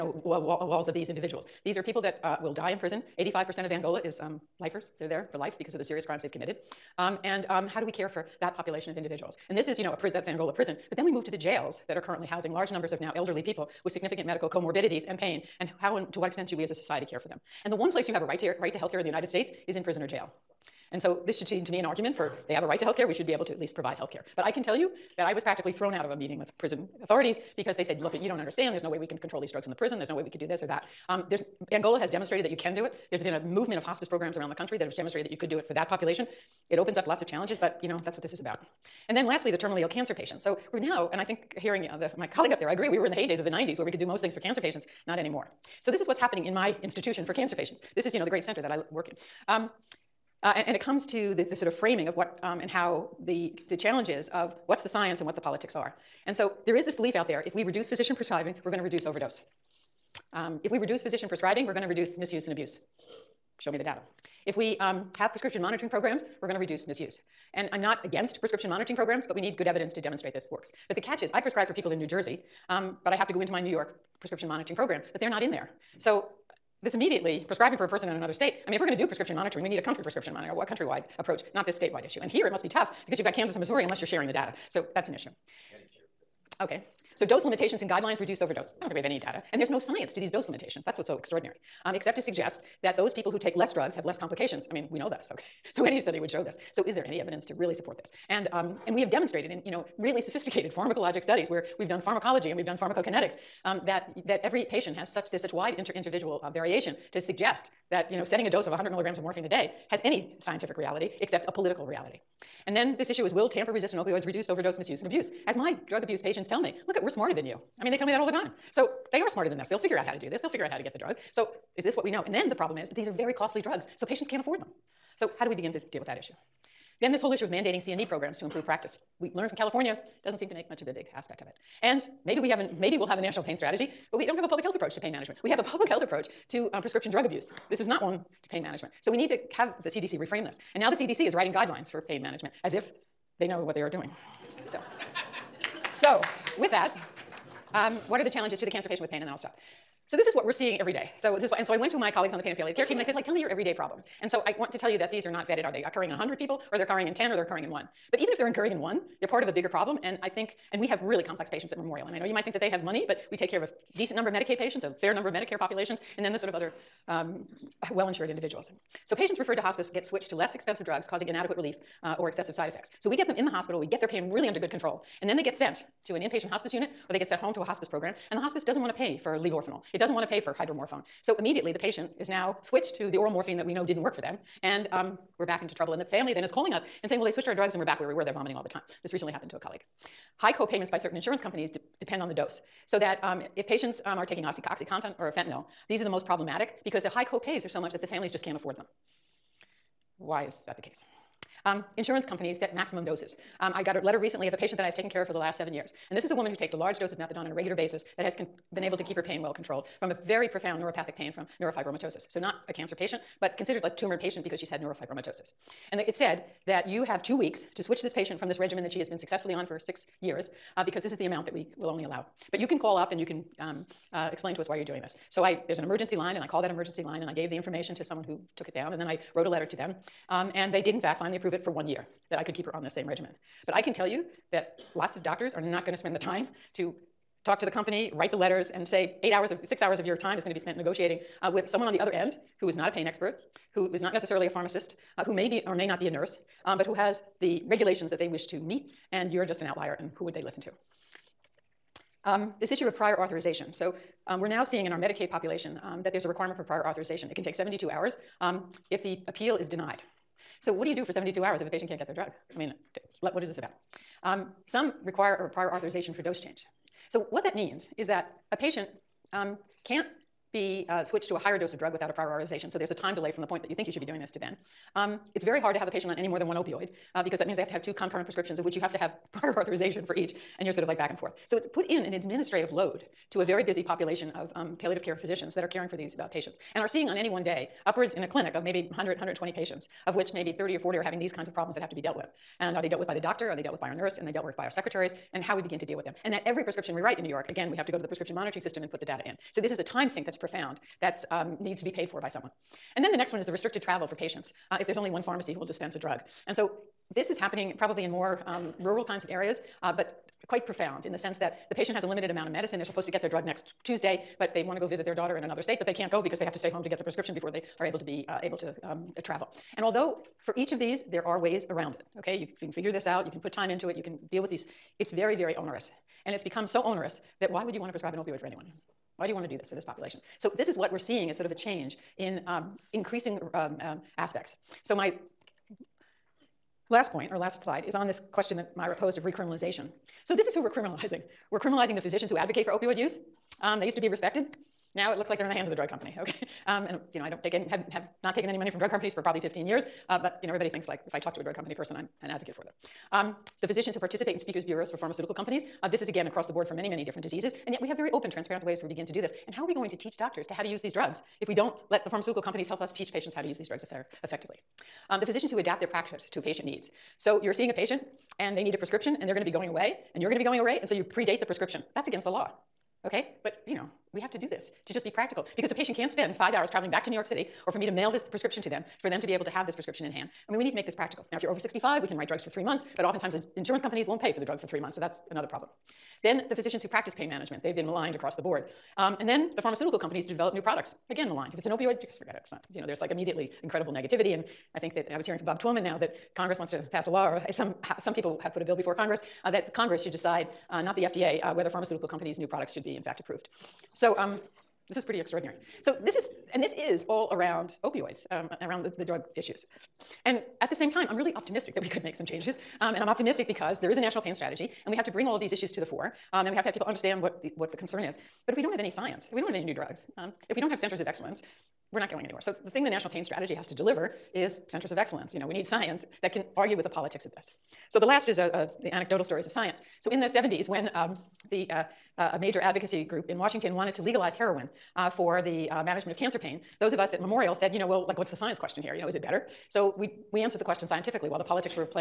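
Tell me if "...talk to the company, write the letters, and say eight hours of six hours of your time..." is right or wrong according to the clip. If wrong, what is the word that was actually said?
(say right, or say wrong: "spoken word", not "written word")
right.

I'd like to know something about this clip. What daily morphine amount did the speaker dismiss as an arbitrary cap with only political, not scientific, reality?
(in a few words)
100 milligrams.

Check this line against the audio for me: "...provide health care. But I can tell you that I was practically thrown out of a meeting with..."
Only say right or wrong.
right.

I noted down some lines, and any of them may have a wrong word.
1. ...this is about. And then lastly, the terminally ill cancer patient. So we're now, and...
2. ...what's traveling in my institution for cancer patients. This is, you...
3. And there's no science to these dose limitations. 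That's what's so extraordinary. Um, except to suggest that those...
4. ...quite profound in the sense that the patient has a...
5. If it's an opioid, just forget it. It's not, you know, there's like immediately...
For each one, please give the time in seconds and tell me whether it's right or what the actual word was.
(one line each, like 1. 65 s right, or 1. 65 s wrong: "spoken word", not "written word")
1. 38 s right
2. 46 s wrong: "happening", not "traveling"
3. 89 s right
4. 310 s right
5. 391 s right.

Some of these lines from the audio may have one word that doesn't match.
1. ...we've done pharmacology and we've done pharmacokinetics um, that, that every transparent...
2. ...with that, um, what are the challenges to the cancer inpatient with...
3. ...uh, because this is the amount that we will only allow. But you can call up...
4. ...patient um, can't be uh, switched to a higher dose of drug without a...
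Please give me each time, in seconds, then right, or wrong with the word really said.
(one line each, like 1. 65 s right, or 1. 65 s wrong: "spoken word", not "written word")
1. 101 s wrong: "patient", not "transparent"
2. 146 s wrong: "patient", not "inpatient"
3. 220 s right
4. 268 s right.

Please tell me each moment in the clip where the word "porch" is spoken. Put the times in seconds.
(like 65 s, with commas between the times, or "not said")
not said.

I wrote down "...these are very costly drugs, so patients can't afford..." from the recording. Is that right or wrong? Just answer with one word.
right.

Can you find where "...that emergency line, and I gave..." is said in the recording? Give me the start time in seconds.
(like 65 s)
226 s.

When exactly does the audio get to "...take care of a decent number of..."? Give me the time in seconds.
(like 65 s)
163 s.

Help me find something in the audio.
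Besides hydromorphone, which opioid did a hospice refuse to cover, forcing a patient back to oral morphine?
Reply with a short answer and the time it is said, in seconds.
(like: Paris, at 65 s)
levorphanol, at 179 s.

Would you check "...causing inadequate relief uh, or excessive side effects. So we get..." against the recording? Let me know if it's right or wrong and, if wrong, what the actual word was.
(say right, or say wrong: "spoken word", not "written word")
right.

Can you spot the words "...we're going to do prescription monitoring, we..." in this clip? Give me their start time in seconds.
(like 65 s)
78 s.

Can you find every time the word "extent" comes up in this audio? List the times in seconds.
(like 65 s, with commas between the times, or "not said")
16 s.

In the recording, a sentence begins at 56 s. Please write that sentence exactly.
And so there is this belief out there, if we reduce physician prescribing, we're gonna reduce overdose.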